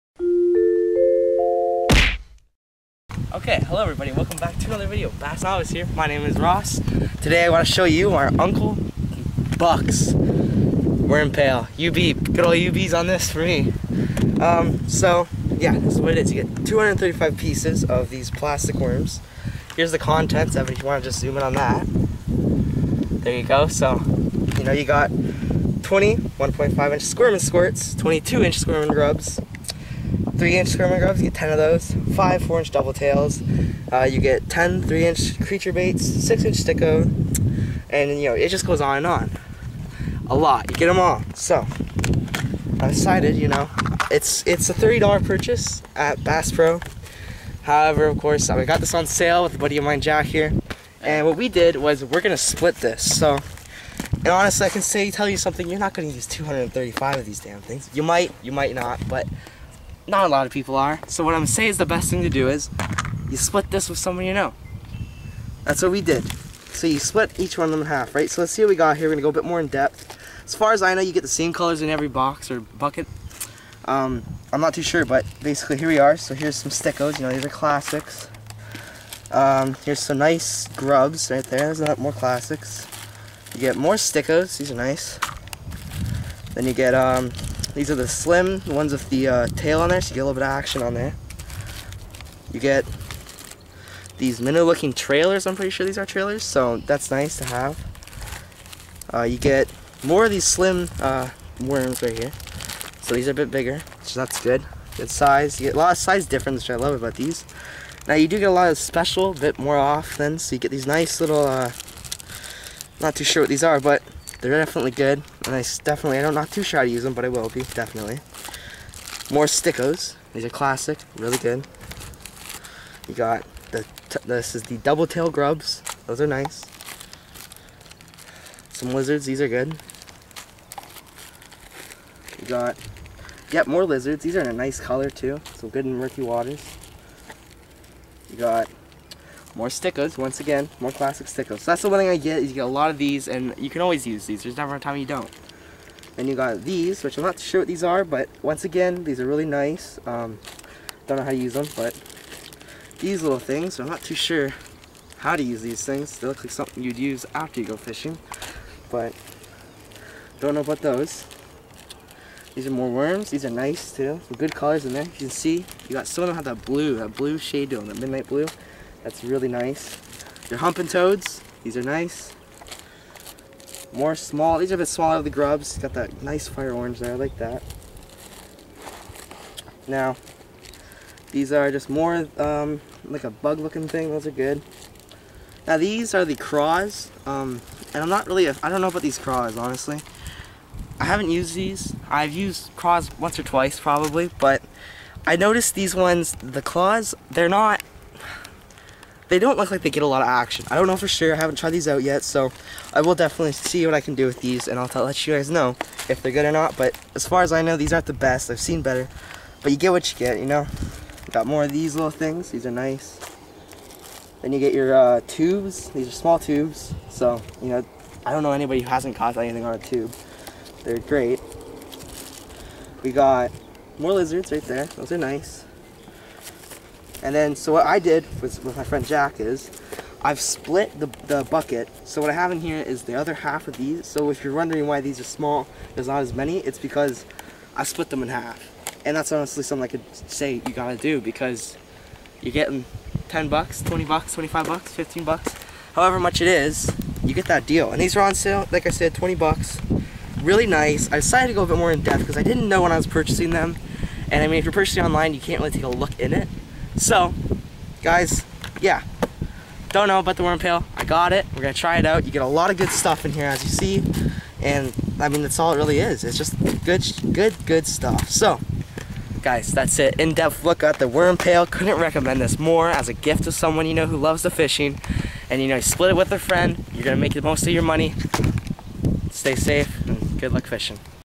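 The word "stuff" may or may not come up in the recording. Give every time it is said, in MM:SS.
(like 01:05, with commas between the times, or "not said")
04:22, 04:27.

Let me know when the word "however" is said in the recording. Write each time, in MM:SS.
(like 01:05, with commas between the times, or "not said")
00:47, 04:05.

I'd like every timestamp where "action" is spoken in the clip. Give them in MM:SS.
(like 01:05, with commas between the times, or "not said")
01:30, 03:20.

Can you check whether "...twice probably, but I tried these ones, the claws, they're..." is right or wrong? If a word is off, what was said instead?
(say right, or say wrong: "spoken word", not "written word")
wrong: "noticed", not "tried".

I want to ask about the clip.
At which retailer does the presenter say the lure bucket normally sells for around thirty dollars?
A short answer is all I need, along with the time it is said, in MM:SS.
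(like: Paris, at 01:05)
Bass Pro, at 00:46.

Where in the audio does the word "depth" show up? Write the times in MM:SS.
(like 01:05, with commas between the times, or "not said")
01:09, 04:12, 04:30.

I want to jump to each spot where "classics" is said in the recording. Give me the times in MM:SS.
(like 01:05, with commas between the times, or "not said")
01:17, 01:22, 02:00, 02:20.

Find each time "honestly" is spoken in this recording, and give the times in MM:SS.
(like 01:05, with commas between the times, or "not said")
00:54, 03:09, 03:59.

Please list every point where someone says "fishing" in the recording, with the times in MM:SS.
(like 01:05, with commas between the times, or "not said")
02:37, 04:34, 04:40.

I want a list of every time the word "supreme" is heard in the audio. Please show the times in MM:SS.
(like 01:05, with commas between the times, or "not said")
not said.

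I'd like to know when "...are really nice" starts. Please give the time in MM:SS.
02:29.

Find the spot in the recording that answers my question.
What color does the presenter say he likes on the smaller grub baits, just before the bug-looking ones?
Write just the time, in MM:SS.
02:56.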